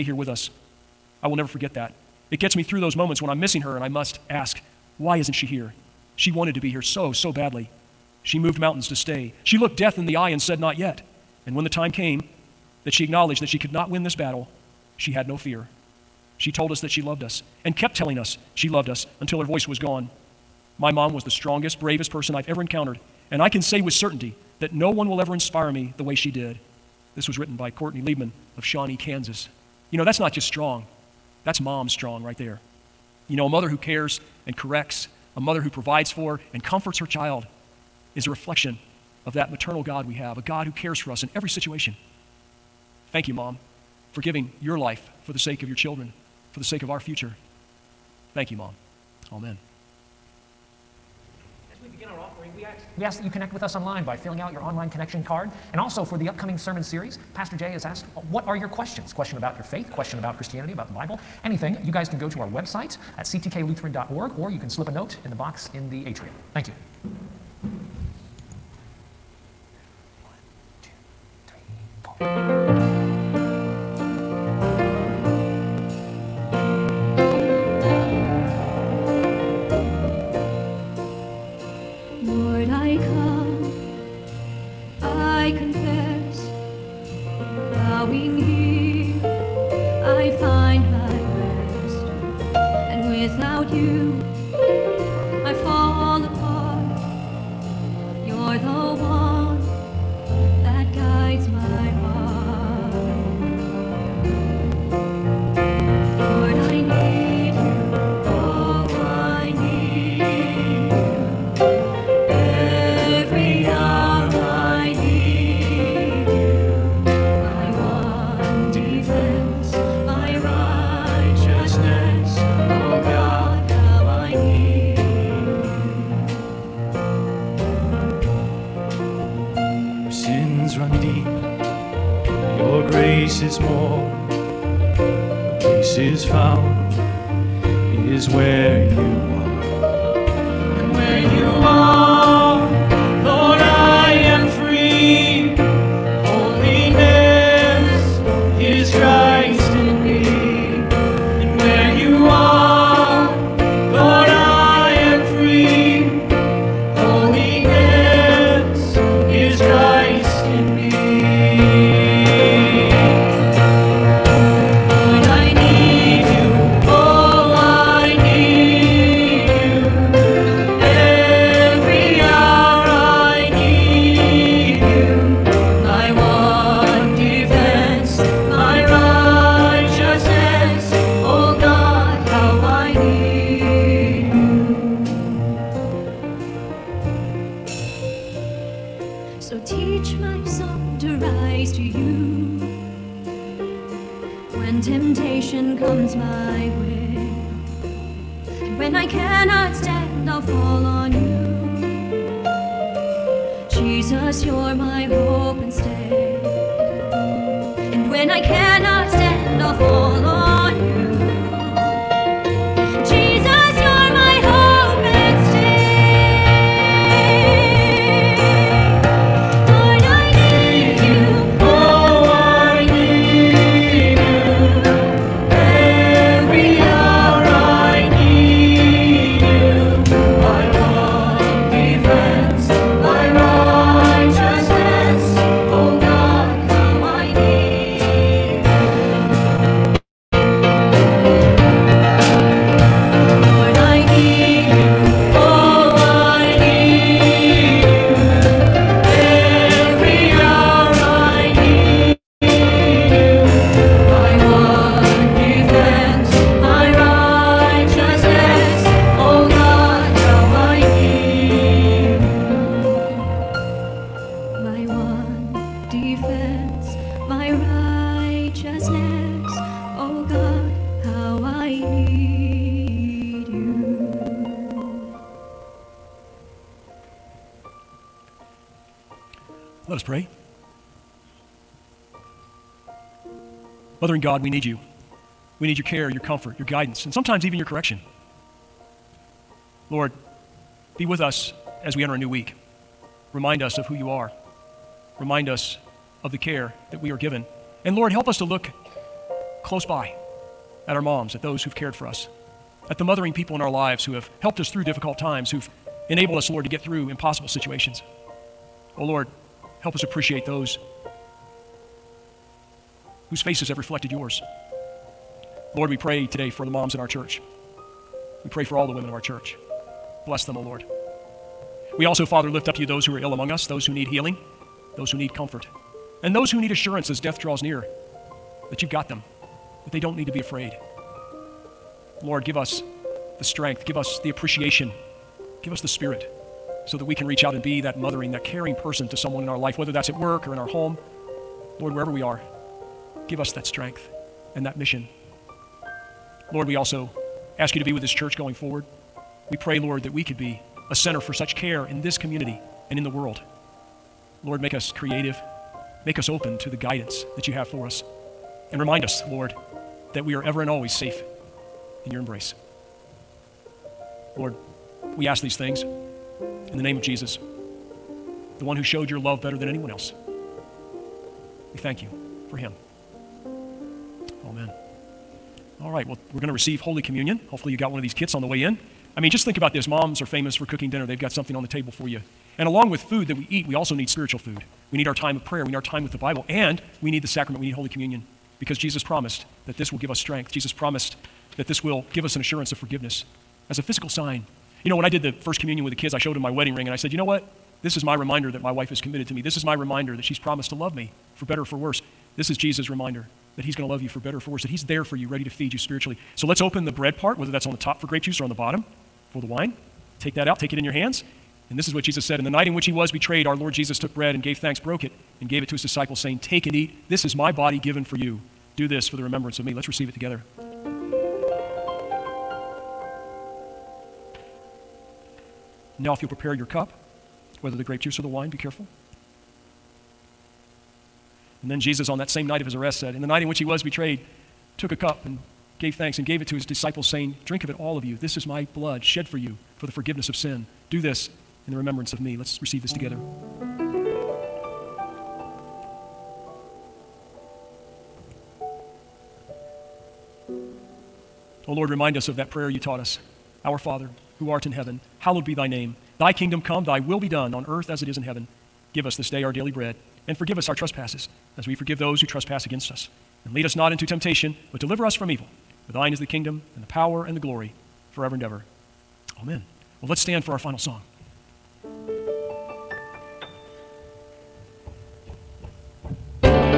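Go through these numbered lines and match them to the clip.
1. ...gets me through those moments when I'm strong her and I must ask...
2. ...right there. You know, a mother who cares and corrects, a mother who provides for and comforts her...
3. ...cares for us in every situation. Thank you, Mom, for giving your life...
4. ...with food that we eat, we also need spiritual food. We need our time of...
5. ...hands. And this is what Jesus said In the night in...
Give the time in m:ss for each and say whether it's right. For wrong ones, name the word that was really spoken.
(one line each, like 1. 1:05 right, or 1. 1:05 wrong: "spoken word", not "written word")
1. 0:02 wrong: "missing", not "strong"
2. 0:32 right
3. 0:40 right
4. 6:22 right
5. 6:50 right.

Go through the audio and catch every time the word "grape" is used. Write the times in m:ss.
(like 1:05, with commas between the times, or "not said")
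6:48, 7:07.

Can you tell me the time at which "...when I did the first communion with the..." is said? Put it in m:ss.
6:34.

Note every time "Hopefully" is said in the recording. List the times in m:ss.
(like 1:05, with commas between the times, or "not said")
6:17.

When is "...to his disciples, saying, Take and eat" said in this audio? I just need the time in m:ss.
6:55.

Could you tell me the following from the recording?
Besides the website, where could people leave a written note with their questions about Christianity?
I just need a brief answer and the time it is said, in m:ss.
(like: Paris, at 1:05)
the box in the atrium, at 1:05.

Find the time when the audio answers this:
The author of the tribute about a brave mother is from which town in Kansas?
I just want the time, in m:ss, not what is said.
0:28.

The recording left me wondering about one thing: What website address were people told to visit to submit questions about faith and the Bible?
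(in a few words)
ctklutheran.org.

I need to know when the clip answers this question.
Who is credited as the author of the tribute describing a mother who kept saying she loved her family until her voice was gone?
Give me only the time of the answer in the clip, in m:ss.
0:27.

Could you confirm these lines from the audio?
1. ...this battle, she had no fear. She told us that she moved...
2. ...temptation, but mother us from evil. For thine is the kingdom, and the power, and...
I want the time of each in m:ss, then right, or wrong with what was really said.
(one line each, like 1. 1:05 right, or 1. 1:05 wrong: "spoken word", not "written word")
1. 0:14 wrong: "loved", not "moved"
2. 7:44 wrong: "deliver", not "mother".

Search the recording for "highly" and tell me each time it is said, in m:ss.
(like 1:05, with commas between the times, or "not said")
not said.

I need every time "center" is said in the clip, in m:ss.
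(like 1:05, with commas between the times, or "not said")
5:50.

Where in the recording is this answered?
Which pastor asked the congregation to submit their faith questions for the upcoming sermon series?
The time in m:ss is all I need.
0:57.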